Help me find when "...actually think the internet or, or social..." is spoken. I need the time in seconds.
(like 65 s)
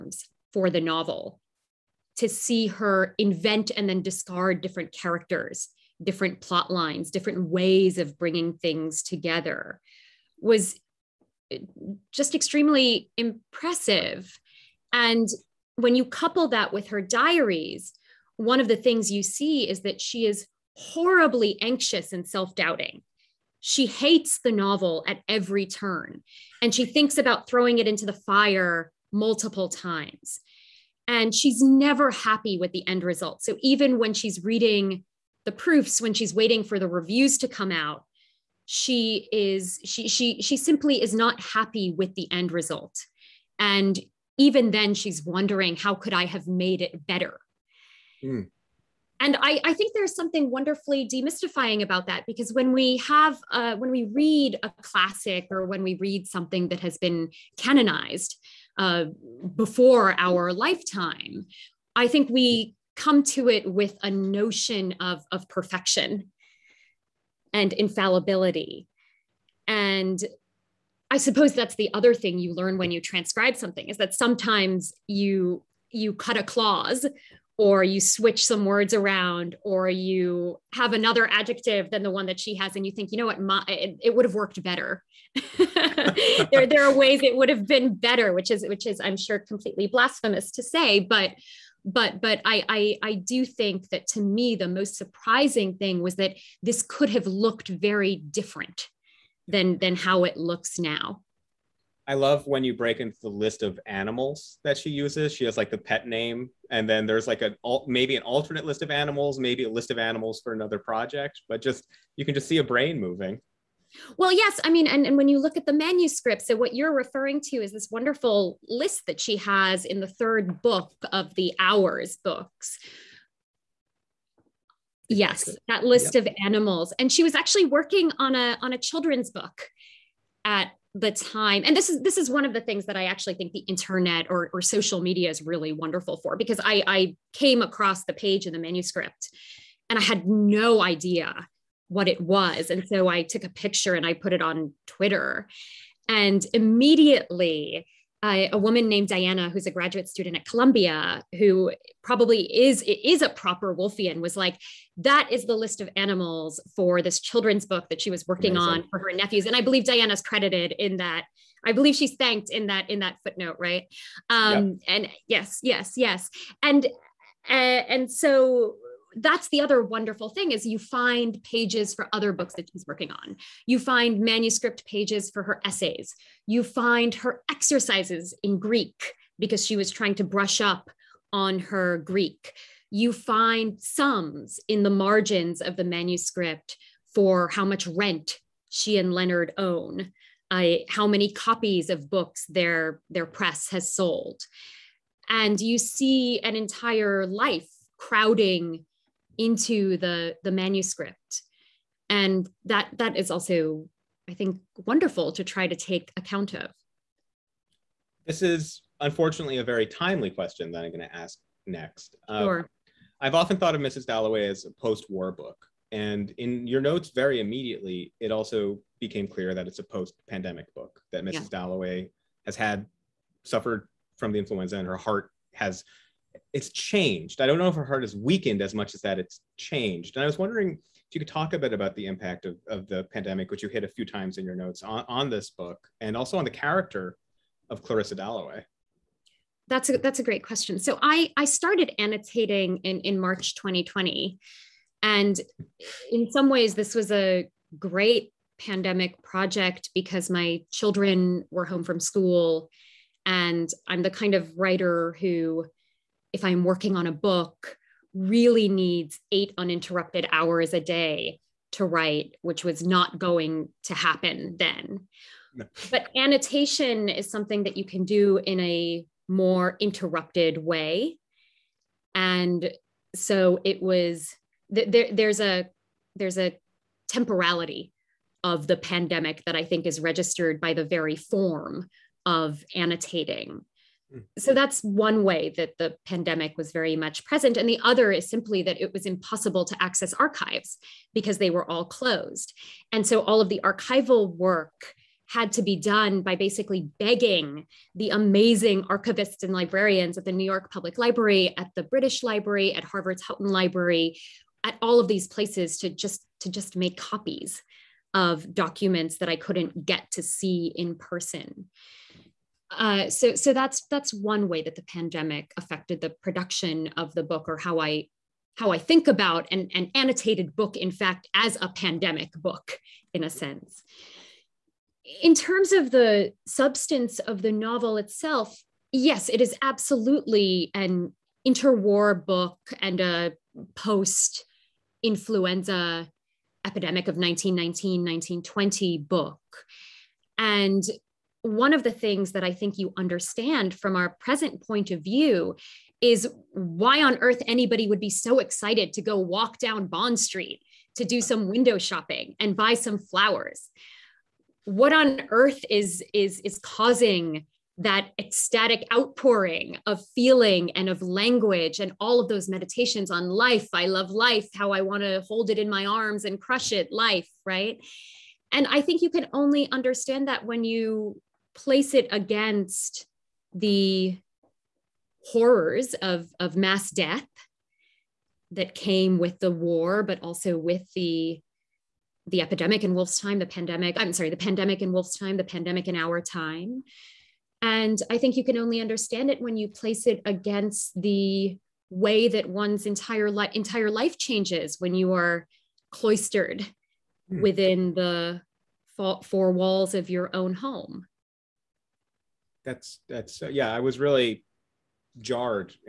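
133 s.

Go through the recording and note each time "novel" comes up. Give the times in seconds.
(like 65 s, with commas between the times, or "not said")
0 s, 24 s, 327 s.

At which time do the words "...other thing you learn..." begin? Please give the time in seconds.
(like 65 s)
71 s.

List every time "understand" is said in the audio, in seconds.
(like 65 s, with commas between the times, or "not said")
342 s, 369 s, 388 s.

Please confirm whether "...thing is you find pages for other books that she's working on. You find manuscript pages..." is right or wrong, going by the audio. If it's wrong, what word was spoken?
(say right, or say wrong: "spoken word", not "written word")
right.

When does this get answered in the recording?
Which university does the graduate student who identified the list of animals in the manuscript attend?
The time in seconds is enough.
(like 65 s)
150 s.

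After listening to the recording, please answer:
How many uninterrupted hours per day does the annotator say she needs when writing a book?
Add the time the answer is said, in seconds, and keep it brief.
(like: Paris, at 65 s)
8, at 259 s.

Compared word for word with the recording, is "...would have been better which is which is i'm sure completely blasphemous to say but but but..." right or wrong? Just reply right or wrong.
right.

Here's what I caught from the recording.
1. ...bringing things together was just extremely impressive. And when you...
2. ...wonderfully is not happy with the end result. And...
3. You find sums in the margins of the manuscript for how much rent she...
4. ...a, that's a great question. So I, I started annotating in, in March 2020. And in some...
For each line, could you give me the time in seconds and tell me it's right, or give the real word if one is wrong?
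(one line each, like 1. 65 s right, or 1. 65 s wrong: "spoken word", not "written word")
1. 8 s right
2. 40 s wrong: "simply", not "wonderfully"
3. 182 s right
4. 239 s right.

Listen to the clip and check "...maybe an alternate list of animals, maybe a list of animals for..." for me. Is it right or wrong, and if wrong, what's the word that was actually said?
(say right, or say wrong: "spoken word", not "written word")
right.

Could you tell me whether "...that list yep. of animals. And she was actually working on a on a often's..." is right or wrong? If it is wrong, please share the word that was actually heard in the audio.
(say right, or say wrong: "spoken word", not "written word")
wrong: "children", not "often".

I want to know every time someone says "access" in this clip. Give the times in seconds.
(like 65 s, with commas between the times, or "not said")
289 s.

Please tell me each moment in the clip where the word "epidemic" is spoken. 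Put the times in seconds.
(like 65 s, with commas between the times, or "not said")
336 s, 382 s.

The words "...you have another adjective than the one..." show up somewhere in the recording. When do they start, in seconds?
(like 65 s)
79 s.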